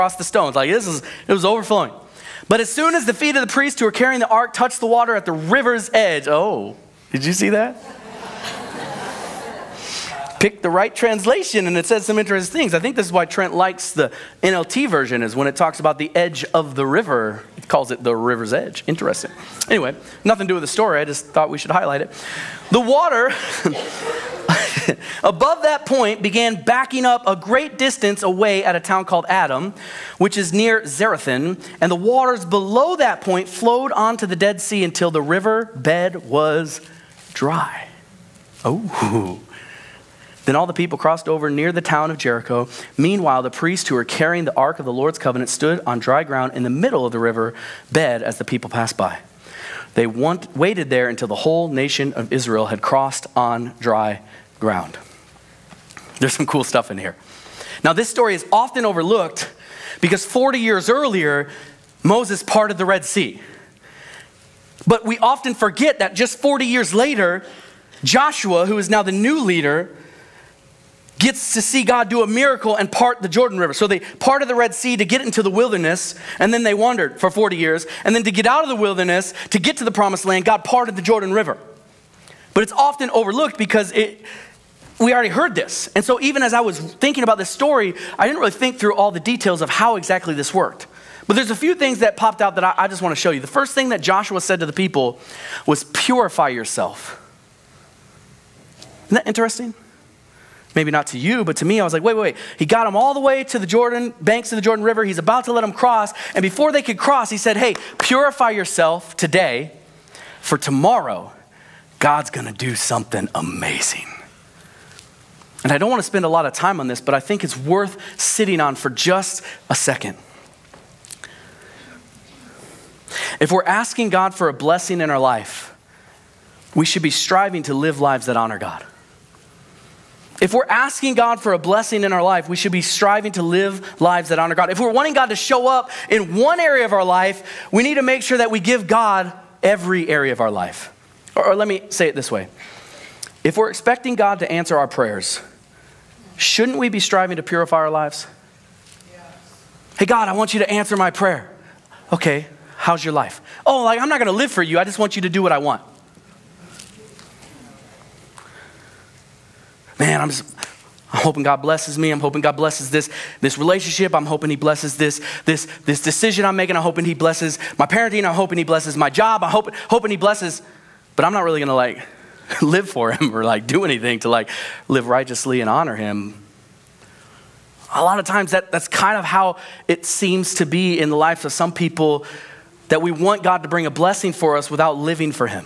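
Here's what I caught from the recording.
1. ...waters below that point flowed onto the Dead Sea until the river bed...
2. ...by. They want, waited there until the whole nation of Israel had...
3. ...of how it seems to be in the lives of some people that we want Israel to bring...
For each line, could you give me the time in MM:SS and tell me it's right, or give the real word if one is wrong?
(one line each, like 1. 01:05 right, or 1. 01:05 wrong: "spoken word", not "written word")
1. 00:31 right
2. 00:48 right
3. 02:59 wrong: "God", not "Israel".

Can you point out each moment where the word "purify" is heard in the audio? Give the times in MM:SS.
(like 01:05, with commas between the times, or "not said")
01:35, 01:47, 02:27.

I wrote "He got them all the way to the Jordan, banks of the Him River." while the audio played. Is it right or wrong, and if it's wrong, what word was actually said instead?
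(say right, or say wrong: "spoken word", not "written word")
wrong: "Jordan", not "Him".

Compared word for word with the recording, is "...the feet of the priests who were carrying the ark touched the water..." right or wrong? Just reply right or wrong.
right.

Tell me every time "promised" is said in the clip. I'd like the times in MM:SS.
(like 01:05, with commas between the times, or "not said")
01:19.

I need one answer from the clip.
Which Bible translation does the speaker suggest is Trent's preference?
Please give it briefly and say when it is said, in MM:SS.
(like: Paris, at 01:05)
NLT, at 00:14.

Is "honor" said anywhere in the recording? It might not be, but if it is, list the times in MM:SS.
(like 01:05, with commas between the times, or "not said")
02:08, 02:14, 02:55.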